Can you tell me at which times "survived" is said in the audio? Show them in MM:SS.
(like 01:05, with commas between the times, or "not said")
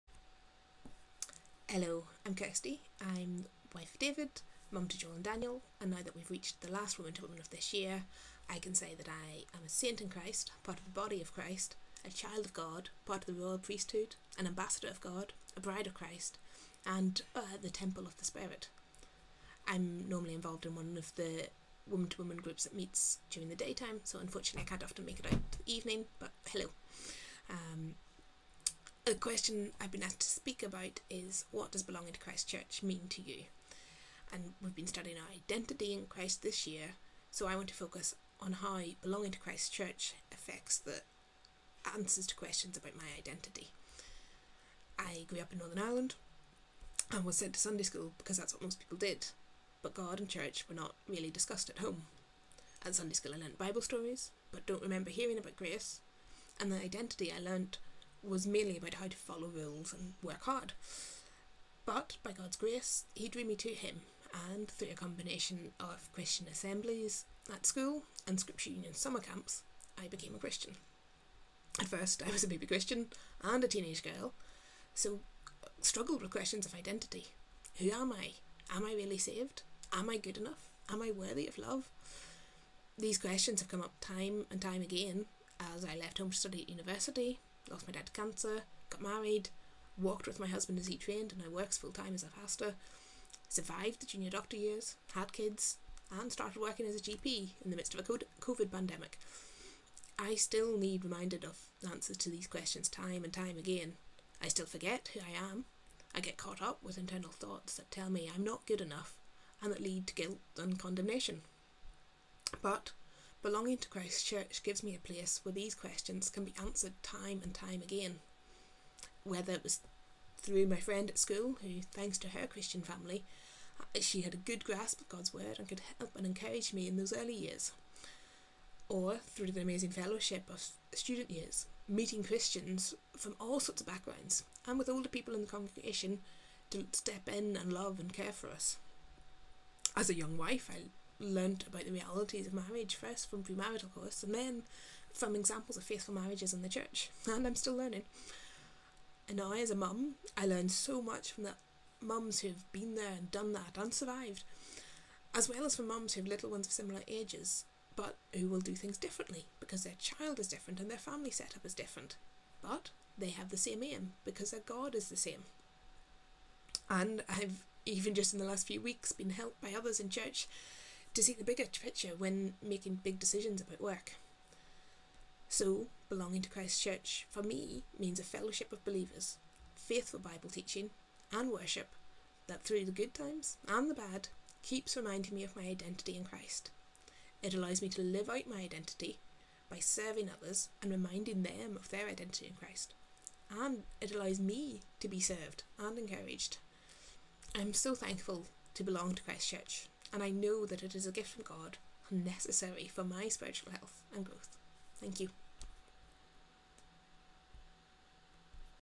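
01:33, 02:33.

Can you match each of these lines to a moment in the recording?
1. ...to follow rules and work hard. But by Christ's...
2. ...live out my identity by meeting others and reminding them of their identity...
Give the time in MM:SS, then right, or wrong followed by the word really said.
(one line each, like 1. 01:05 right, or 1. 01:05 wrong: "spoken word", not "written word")
1. 00:59 wrong: "God", not "Christ"
2. 03:08 wrong: "serving", not "meeting".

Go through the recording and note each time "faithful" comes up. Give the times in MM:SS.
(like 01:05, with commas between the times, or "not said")
02:25, 02:59.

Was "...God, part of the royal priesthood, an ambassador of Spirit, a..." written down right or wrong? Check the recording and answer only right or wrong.
wrong.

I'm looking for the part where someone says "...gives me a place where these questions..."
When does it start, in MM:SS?
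01:54.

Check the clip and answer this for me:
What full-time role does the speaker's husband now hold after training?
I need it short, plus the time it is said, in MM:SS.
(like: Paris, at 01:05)
Pastor, at 01:32.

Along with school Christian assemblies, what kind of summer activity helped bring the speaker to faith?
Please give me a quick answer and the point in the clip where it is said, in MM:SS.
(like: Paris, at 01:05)
Scripture Union summer camps, at 01:08.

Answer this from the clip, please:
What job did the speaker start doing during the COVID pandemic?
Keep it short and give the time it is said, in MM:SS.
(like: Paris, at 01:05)
GP, at 01:37.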